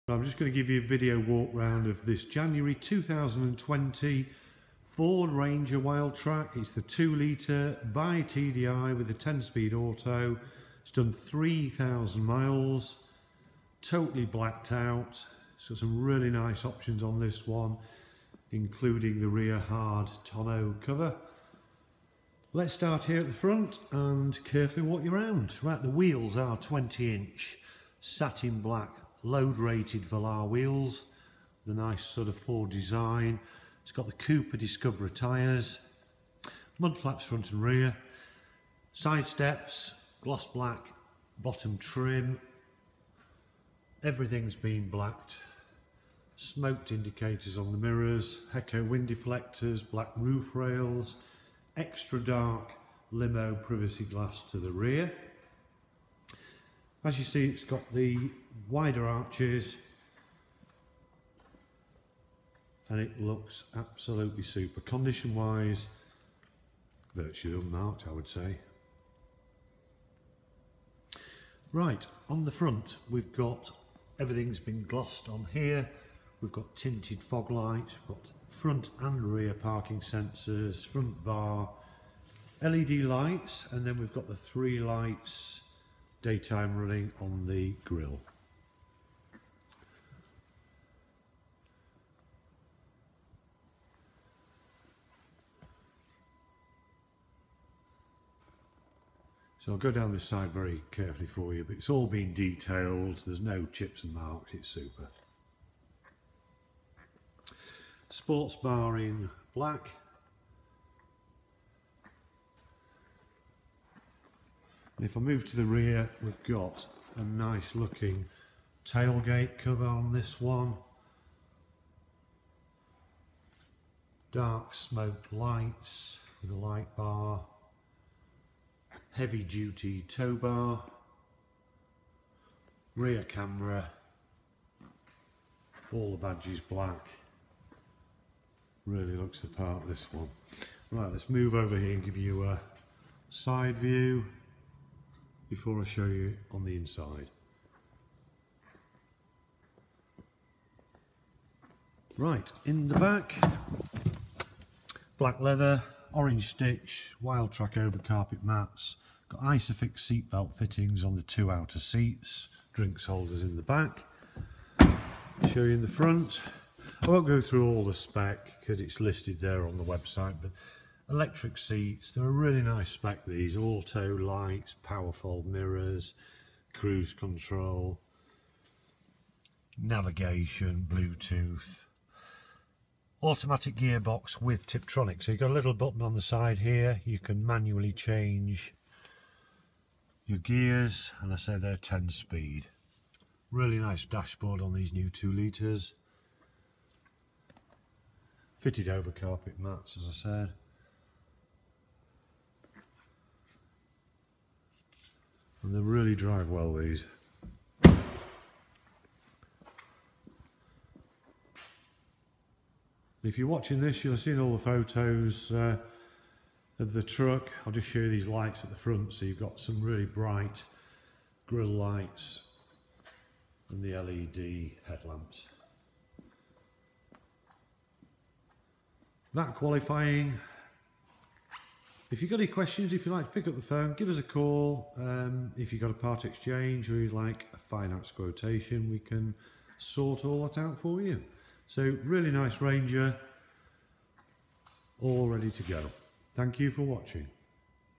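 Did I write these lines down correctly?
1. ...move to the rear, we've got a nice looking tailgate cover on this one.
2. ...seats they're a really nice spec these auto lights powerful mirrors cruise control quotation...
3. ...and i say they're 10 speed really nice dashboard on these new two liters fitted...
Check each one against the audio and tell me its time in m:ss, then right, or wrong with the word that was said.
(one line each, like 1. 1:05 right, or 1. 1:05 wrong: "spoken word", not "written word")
1. 1:55 right
2. 2:51 wrong: "navigation", not "quotation"
3. 3:11 right.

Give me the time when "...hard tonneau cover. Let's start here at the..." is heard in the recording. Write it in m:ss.
0:19.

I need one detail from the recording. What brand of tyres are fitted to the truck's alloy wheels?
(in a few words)
Cooper Discoverer.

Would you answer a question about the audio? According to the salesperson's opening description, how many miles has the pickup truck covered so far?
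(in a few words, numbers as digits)
3,000 miles.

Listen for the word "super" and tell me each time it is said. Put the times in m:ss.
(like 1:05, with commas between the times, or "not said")
1:04, 1:44.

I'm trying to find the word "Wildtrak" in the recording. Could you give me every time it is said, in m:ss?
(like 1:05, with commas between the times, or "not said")
0:05, 2:37.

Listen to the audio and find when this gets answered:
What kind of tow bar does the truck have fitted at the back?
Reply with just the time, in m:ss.
2:09.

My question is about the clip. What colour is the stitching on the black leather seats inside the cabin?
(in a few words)
Orange.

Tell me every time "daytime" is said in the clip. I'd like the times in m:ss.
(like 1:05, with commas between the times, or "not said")
1:26.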